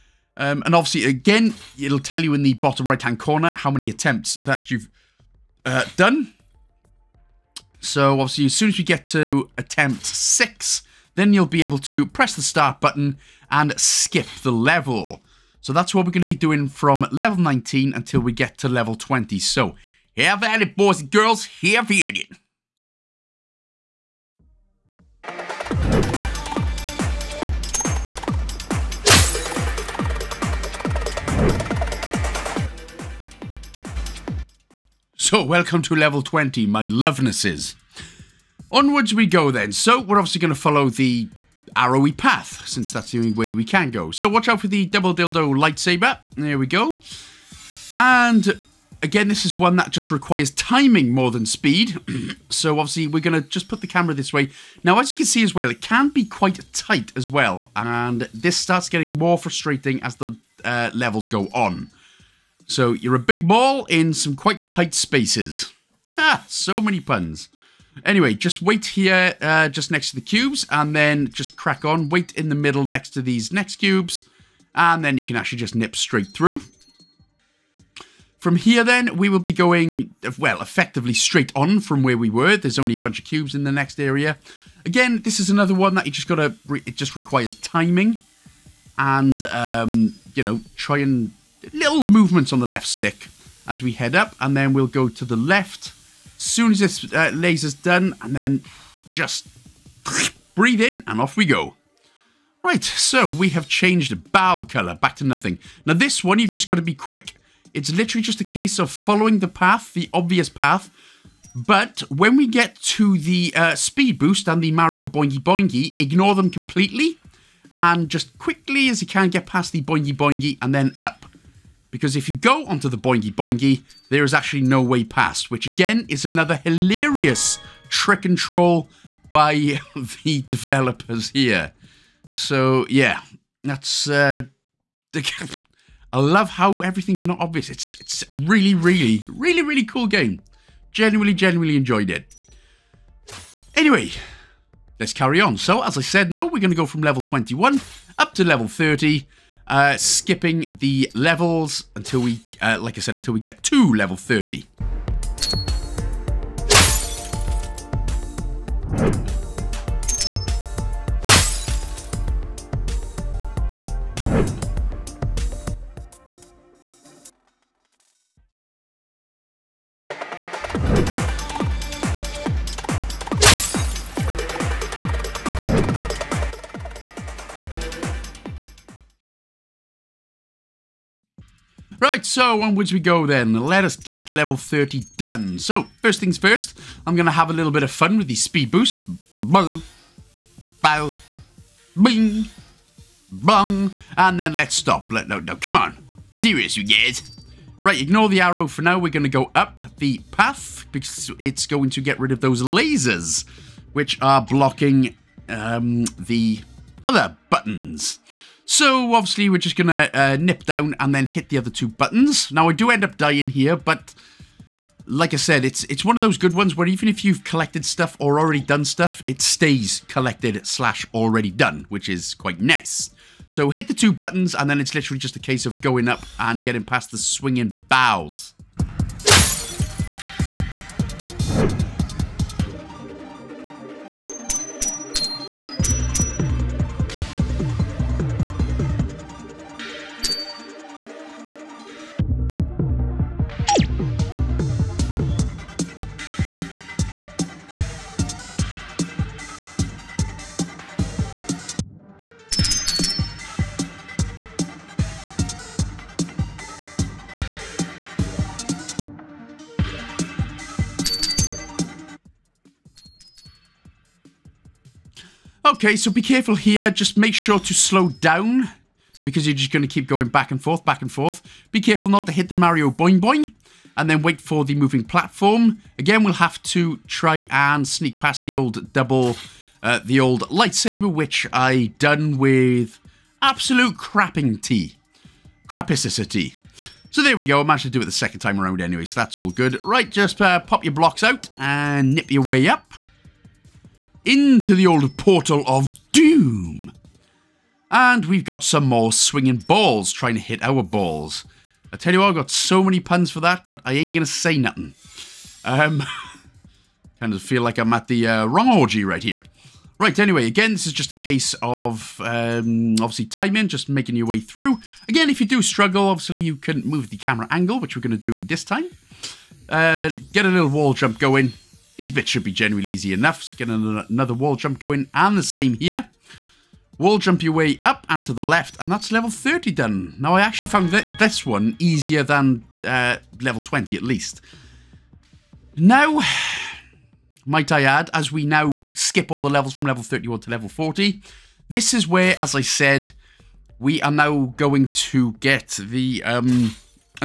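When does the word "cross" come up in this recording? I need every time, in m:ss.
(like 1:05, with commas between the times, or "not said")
not said.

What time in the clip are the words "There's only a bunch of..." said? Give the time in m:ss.
1:22.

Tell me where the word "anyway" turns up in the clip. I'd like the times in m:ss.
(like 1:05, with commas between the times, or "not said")
1:08, 2:23, 4:48, 5:10.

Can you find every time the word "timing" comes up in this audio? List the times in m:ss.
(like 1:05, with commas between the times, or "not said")
0:50, 1:27, 5:13.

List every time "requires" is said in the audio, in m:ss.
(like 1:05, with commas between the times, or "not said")
0:50, 1:27.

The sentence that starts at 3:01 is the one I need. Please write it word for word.
Right, so onwards we go then.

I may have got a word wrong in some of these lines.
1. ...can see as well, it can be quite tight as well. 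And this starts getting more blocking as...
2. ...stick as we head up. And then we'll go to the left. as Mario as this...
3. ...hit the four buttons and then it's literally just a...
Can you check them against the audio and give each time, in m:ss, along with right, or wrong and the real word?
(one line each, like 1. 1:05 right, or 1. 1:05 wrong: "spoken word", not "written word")
1. 0:55 wrong: "frustrating", not "blocking"
2. 1:32 wrong: "Soon", not "Mario"
3. 3:43 wrong: "two", not "four".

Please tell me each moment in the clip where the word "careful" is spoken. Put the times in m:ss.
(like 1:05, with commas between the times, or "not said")
4:26, 4:31.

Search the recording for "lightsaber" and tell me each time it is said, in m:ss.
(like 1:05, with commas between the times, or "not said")
0:45, 4:40.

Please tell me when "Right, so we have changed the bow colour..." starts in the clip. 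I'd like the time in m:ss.
1:42.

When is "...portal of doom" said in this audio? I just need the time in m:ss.
4:55.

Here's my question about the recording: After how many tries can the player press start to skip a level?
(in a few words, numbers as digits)
6.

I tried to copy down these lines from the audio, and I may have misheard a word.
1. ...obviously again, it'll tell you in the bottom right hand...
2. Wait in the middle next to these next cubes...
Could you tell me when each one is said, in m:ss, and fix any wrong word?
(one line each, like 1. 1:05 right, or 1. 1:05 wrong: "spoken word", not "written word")
1. 0:00 right
2. 1:12 right.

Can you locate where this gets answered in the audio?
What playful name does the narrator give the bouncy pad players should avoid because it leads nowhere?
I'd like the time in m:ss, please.
1:54.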